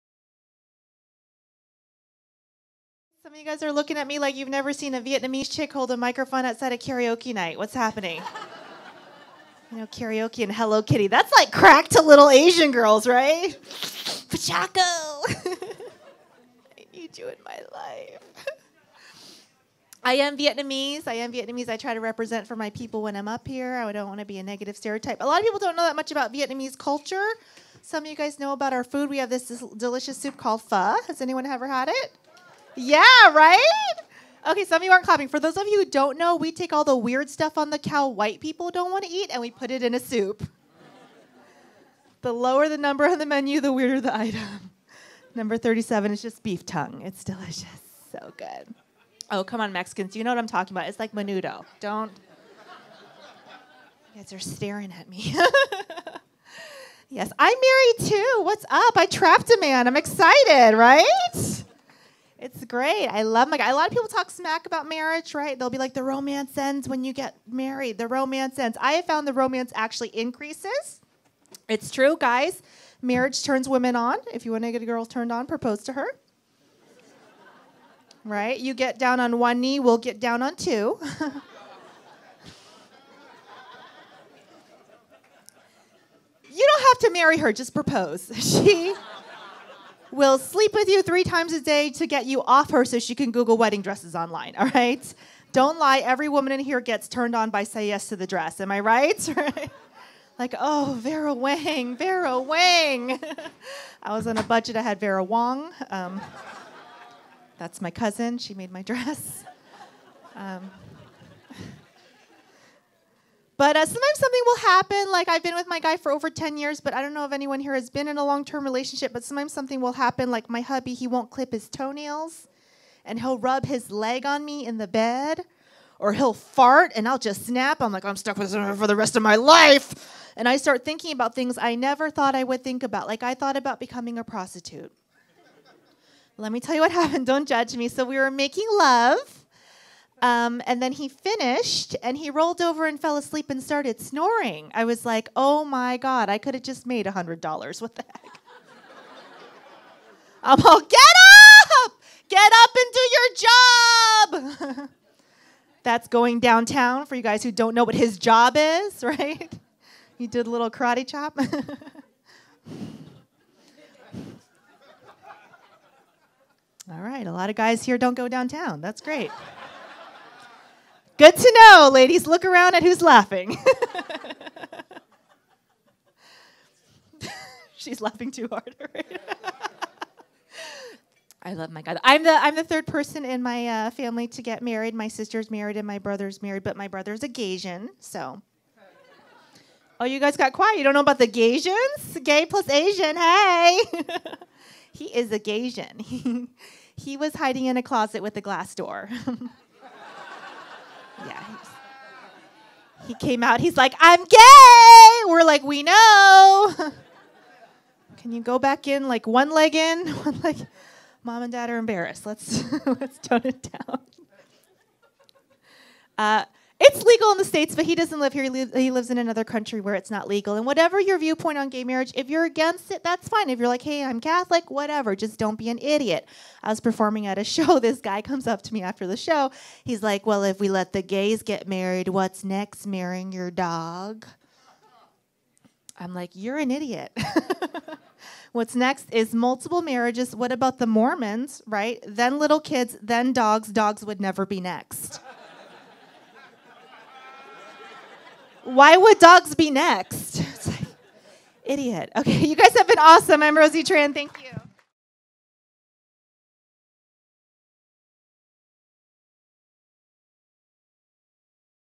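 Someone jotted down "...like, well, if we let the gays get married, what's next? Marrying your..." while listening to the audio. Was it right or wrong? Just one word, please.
right.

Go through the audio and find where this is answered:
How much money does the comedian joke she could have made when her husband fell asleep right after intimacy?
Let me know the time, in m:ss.
2:27.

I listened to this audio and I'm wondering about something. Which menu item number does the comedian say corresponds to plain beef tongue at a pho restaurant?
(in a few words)
37.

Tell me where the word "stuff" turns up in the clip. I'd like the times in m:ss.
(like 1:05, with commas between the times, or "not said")
0:37.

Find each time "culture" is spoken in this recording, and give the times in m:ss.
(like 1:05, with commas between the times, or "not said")
0:26.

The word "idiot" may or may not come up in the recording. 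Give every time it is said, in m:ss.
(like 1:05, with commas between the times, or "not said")
3:45, 3:56, 4:11.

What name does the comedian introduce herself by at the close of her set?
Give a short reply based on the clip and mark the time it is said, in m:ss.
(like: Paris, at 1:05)
Rosie Tran, at 4:13.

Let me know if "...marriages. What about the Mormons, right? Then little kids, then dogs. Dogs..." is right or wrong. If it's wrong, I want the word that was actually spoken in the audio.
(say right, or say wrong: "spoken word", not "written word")
right.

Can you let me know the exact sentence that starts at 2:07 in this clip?
I'm like, I'm stuck with him for the rest of my life.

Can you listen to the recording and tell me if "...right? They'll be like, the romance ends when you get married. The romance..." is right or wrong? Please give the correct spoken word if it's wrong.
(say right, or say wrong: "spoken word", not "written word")
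right.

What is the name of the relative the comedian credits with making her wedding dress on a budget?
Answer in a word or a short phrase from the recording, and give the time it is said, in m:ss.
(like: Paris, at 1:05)
Vera Wong, at 1:44.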